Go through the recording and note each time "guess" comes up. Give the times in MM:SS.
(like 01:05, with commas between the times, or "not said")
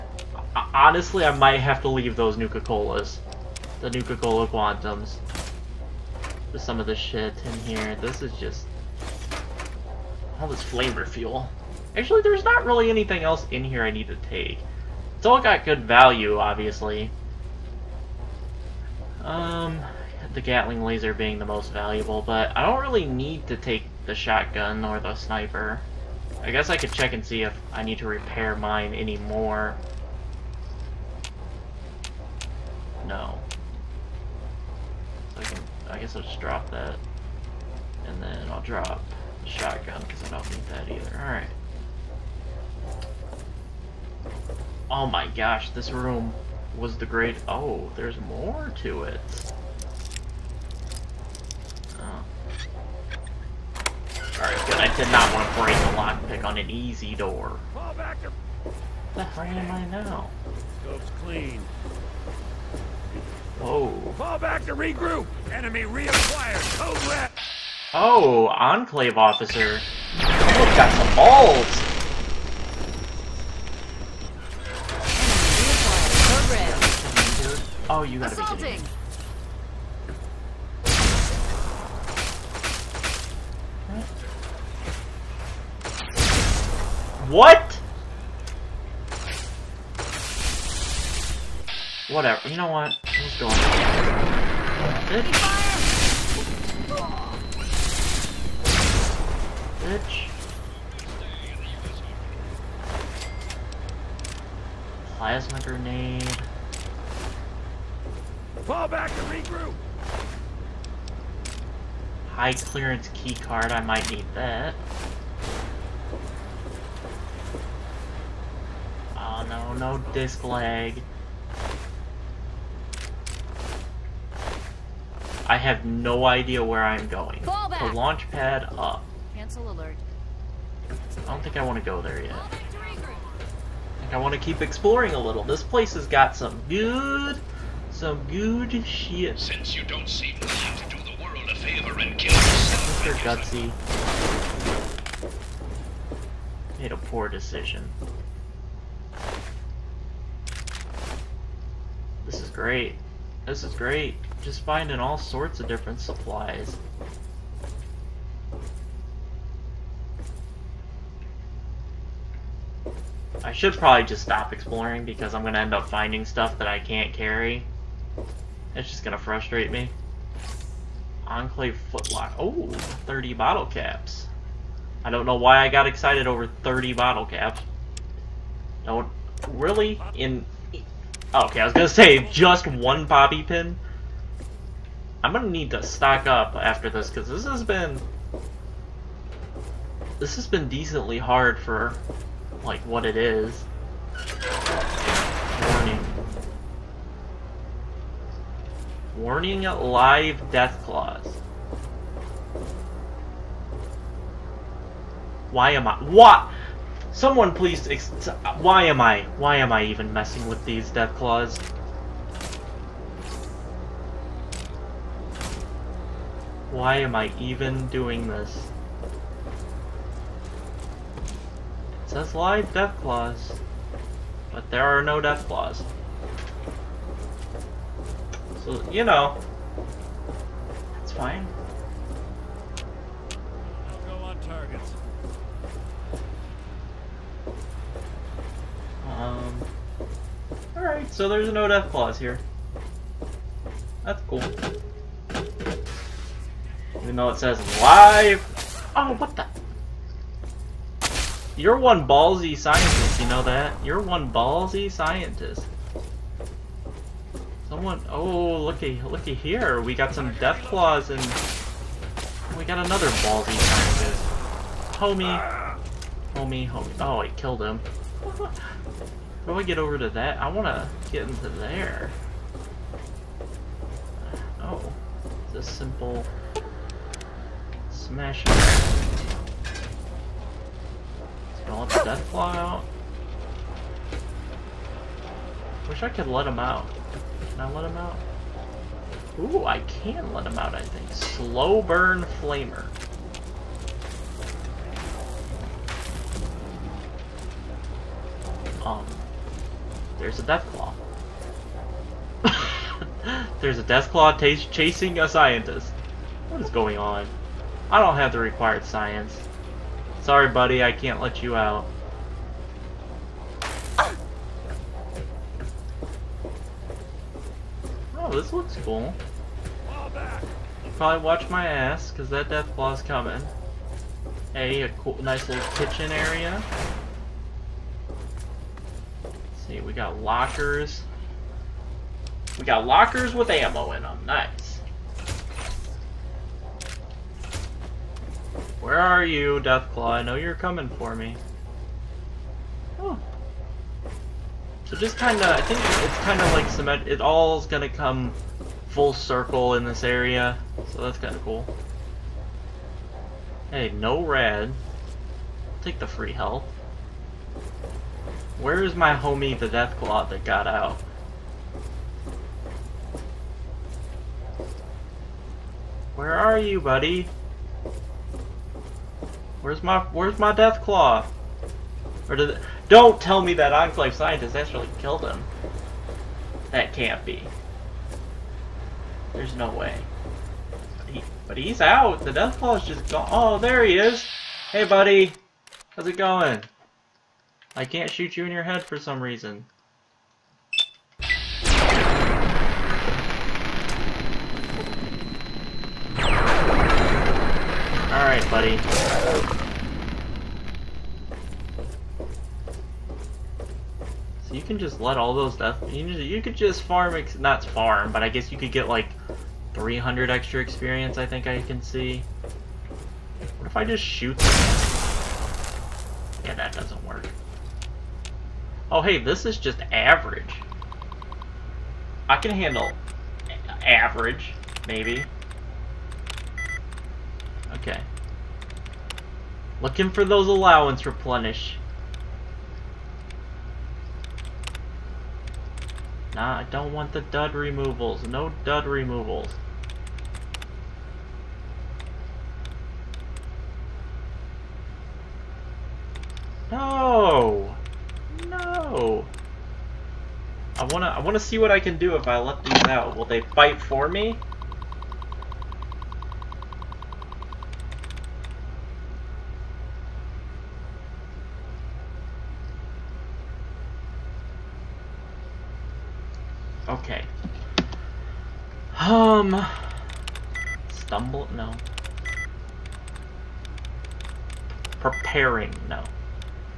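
00:26, 00:35, 06:48.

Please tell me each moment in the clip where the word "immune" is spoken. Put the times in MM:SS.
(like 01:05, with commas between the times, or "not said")
not said.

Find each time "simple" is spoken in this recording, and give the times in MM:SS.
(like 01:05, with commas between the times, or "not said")
04:35.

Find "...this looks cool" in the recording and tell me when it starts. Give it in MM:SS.
05:18.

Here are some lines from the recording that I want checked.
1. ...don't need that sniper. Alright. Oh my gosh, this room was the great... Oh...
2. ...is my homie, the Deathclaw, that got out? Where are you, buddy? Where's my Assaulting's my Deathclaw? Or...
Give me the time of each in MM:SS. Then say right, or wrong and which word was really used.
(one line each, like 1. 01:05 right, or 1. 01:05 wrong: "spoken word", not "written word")
1. 00:40 wrong: "either", not "sniper"
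2. 05:58 wrong: "Where", not "Assaulting".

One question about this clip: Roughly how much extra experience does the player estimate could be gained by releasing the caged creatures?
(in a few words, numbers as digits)
300.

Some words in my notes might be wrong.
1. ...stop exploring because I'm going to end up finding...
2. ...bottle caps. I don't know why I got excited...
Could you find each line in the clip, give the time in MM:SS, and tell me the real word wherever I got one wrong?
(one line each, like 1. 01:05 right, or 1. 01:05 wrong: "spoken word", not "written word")
1. 02:44 right
2. 02:53 right.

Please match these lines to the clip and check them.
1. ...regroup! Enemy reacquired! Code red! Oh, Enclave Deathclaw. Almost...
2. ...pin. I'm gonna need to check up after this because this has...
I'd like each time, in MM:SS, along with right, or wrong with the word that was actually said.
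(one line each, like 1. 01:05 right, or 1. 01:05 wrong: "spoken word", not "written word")
1. 01:04 wrong: "Officer", not "Deathclaw"
2. 03:03 wrong: "stock", not "check".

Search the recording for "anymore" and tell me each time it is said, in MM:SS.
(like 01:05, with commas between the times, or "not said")
00:28.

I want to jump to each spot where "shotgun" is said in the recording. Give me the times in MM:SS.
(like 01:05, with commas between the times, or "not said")
00:24, 00:39.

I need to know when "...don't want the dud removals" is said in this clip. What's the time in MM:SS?
07:16.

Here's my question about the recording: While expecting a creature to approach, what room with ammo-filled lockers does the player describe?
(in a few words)
Kitchen area.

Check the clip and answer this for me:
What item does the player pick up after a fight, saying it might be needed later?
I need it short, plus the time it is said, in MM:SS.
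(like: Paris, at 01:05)
High clearance key card, at 01:52.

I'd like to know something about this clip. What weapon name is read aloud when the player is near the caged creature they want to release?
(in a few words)
Slow burn flamer.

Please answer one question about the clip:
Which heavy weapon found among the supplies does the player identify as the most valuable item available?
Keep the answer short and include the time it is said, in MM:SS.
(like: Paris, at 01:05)
Gatling laser, at 00:20.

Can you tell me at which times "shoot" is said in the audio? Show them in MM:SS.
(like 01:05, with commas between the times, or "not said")
06:28, 06:54.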